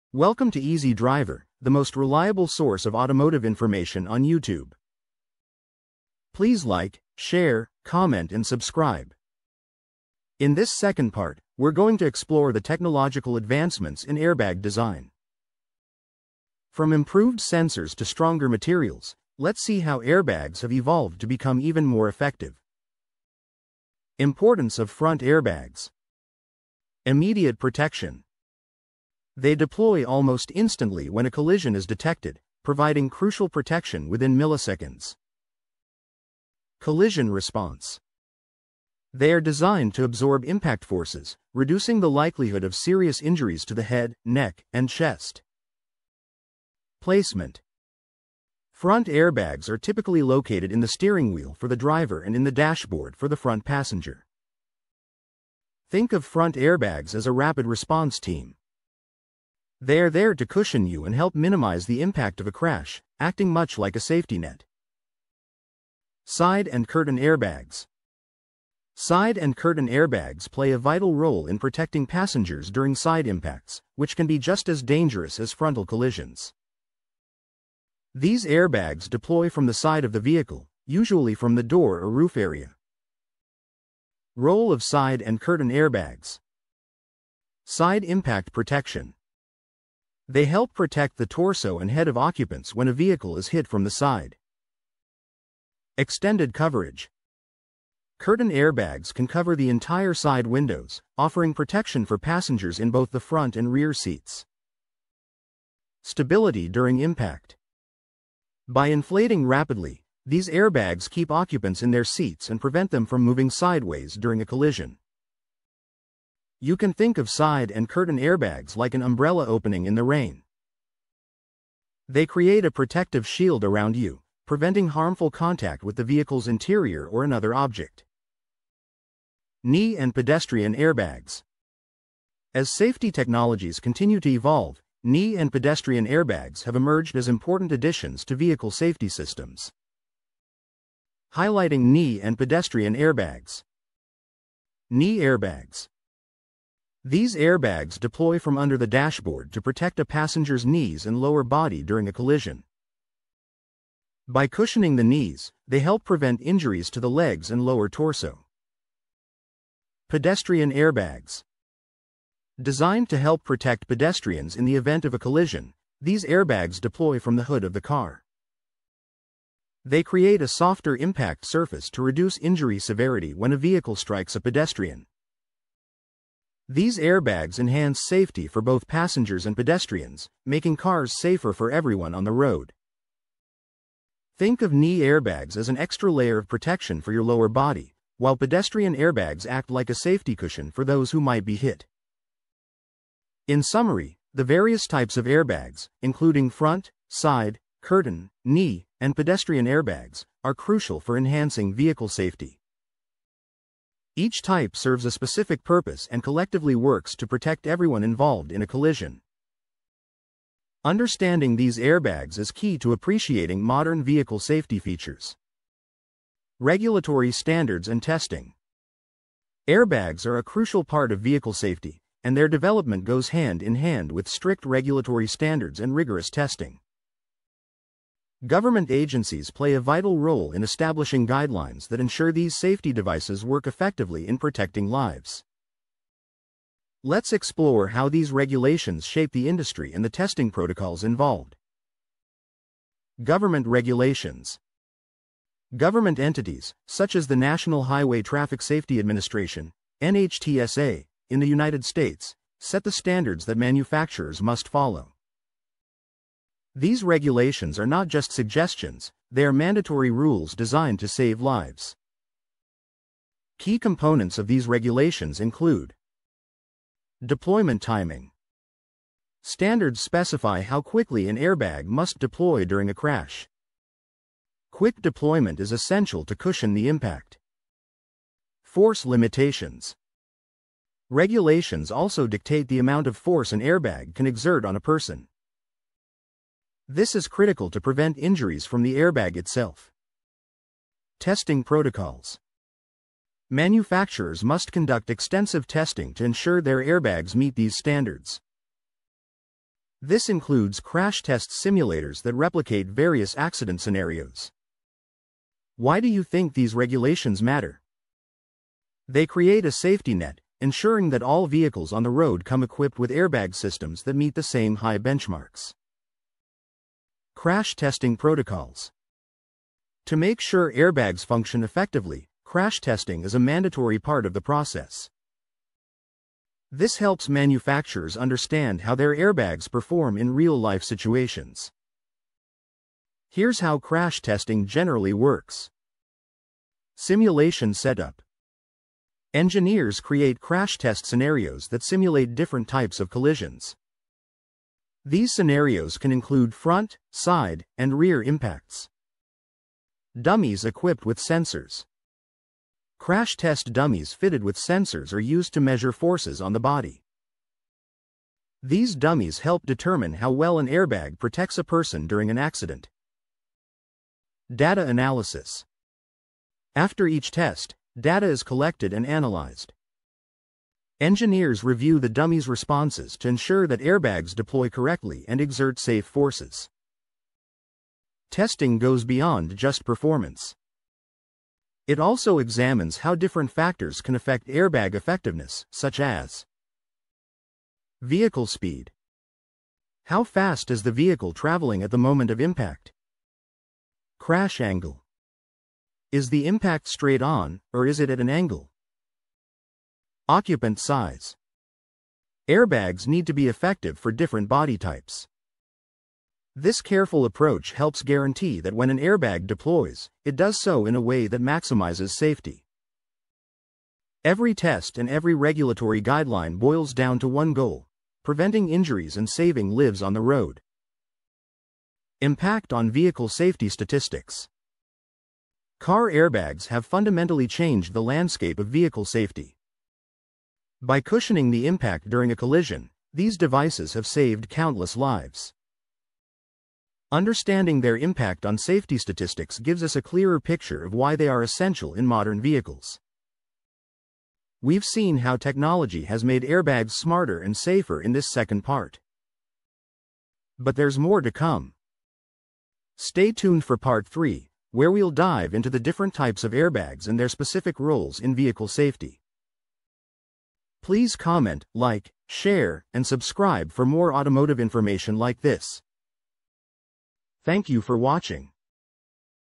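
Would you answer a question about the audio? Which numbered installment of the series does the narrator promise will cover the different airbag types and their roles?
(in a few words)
Part 3.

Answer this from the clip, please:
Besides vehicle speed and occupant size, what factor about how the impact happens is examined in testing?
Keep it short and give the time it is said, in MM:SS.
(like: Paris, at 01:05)
Crash angle, at 06:34.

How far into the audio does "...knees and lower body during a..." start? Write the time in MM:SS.
02:30.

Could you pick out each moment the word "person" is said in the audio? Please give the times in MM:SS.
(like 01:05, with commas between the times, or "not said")
04:44, 06:01.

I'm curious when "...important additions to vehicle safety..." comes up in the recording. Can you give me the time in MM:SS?
02:17.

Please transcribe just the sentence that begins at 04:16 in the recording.
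These regulations are not just suggestions, they are mandatory rules designed to save lives.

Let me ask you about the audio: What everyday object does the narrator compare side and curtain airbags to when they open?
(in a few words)
An umbrella.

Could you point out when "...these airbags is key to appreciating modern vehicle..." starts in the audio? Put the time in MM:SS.
03:31.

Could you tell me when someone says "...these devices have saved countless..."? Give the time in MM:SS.
07:13.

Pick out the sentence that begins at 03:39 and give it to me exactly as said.
Airbags are a crucial part of vehicle safety, and their development goes hand in hand with strict regulatory standards and rigorous testing.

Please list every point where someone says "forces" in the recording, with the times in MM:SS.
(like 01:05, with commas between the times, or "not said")
00:40, 04:38, 04:43, 05:55, 06:16.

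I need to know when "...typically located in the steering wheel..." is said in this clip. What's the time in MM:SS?
00:49.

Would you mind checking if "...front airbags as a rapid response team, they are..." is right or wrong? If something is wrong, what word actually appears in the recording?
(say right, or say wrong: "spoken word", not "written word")
right.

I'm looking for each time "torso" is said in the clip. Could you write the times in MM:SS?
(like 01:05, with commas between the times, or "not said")
01:31, 02:37.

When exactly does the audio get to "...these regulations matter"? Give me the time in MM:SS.
05:06.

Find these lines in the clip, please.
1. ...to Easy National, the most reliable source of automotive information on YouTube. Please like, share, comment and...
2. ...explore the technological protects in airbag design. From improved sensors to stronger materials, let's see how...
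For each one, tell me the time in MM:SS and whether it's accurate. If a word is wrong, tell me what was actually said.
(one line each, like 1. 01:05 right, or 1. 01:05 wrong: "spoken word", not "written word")
1. 00:00 wrong: "Driver", not "National"
2. 00:12 wrong: "advancements", not "protects".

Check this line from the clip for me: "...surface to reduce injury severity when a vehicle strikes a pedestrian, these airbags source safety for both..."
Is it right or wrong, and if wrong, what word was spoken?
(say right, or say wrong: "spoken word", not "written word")
wrong: "enhance", not "source".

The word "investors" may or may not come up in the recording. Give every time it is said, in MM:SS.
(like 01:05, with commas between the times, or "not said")
not said.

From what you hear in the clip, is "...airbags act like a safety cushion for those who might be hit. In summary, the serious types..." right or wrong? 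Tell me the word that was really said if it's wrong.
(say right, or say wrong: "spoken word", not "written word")
wrong: "various", not "serious".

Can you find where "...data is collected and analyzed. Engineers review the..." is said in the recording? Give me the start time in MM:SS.
06:07.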